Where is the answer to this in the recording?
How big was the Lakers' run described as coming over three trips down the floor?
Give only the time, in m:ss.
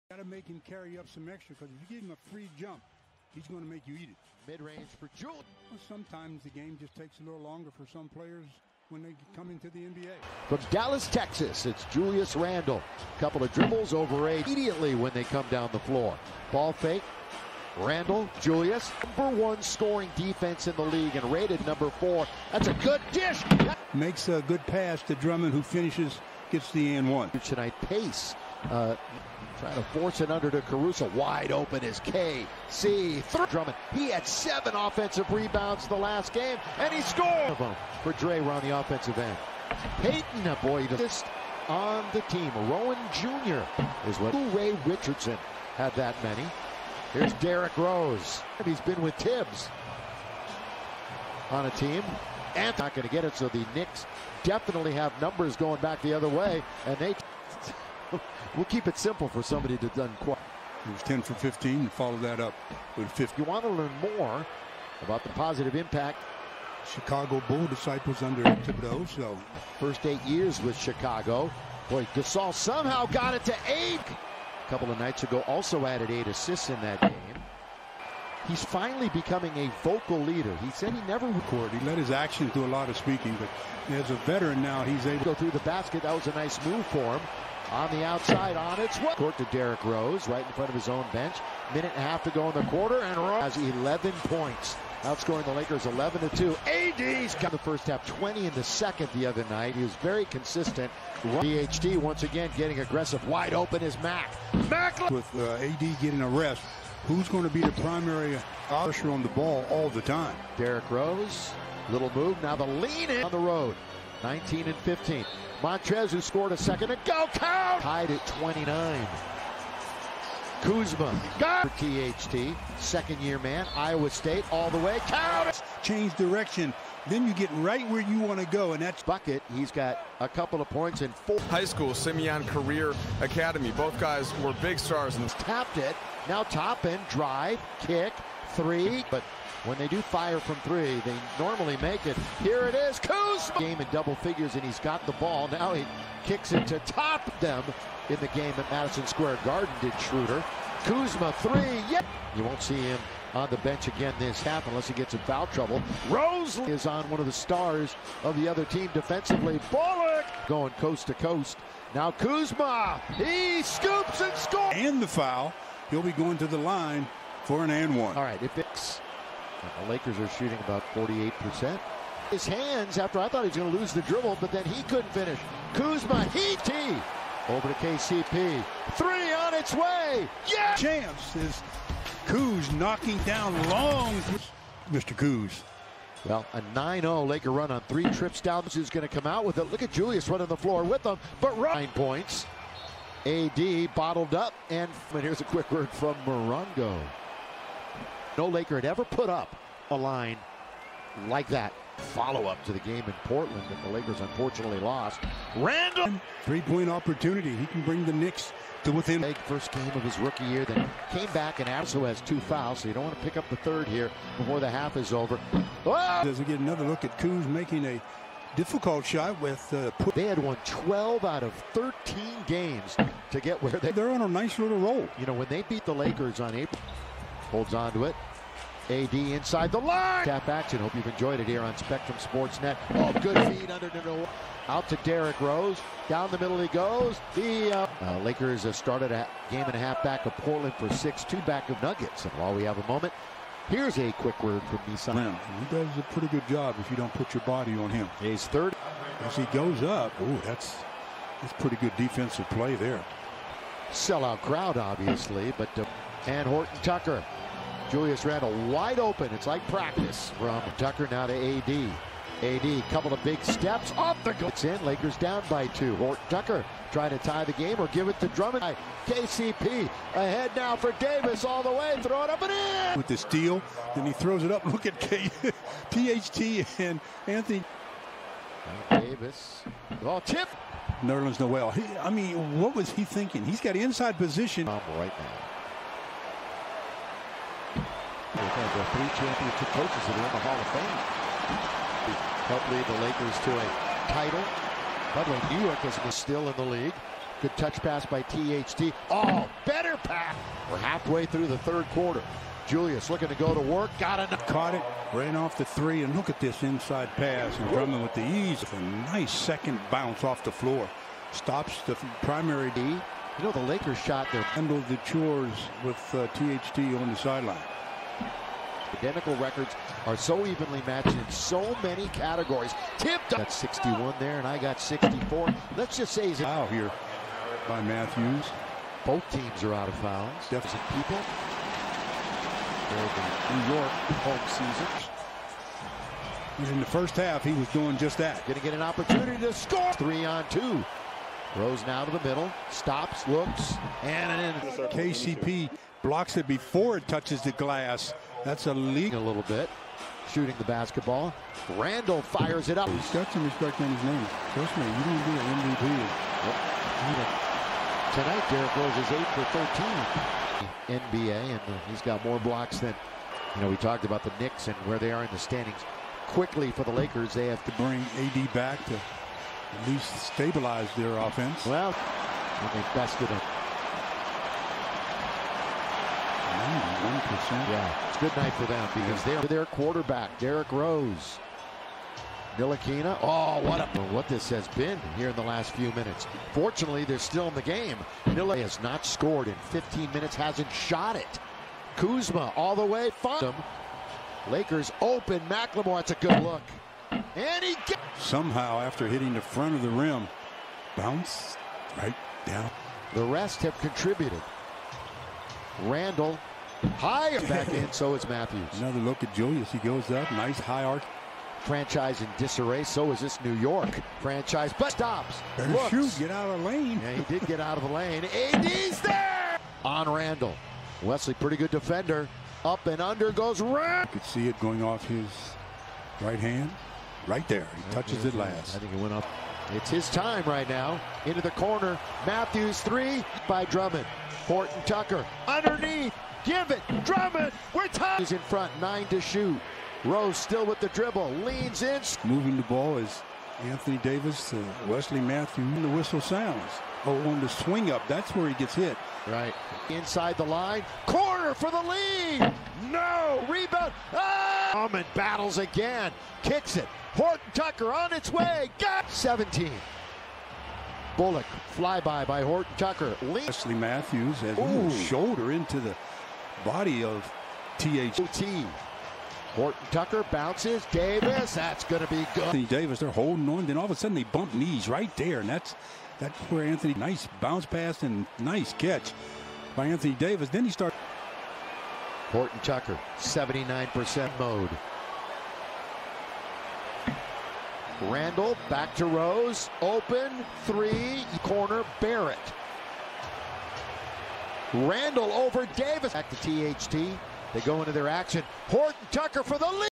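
3:06.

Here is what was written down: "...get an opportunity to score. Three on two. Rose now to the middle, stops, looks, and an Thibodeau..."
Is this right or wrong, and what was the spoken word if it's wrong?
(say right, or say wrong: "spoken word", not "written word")
wrong: "KCP", not "Thibodeau".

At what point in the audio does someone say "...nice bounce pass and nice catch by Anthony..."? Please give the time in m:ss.
7:56.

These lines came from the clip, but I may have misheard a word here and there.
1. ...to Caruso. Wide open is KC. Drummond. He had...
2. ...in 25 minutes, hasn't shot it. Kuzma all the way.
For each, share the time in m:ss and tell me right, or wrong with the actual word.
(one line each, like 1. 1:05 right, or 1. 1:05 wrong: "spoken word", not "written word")
1. 0:30 right
2. 6:29 wrong: "15", not "25".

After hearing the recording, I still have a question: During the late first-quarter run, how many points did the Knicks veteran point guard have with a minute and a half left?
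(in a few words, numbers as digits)
11.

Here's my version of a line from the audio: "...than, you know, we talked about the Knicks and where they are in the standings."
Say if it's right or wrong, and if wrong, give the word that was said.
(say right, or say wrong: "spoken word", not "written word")
right.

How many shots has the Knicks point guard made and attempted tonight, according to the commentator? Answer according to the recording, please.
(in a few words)
8 for 13.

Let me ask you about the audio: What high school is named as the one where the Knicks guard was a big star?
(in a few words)
Simeon Career Academy.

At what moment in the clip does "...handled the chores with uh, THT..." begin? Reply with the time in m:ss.
5:14.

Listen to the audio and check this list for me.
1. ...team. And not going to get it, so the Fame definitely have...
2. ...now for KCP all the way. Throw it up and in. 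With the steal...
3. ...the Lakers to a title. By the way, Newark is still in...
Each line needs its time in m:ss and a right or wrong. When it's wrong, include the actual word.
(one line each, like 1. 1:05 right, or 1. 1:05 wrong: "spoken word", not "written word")
1. 0:51 wrong: "Knicks", not "Fame"
2. 4:30 wrong: "Davis", not "KCP"
3. 4:52 right.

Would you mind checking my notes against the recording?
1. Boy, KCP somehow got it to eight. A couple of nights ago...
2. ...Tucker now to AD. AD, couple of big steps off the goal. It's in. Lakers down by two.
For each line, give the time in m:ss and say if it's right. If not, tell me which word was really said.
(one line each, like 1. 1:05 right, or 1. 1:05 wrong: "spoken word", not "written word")
1. 1:11 wrong: "Gasol", not "KCP"
2. 4:20 right.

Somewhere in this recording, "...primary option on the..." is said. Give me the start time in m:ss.
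1:47.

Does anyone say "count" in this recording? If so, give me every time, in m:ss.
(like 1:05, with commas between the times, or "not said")
1:57, 2:05.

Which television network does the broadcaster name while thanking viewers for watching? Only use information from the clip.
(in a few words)
Spectrum Sports Net.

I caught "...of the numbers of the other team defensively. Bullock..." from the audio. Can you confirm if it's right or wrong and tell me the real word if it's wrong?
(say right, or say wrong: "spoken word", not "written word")
wrong: "stars", not "numbers".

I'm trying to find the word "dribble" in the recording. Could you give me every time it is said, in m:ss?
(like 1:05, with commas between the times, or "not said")
0:13, 2:54, 7:20.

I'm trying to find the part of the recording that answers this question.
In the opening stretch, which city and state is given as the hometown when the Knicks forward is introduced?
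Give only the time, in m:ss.
0:10.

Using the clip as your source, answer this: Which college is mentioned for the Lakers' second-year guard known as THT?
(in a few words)
Iowa State.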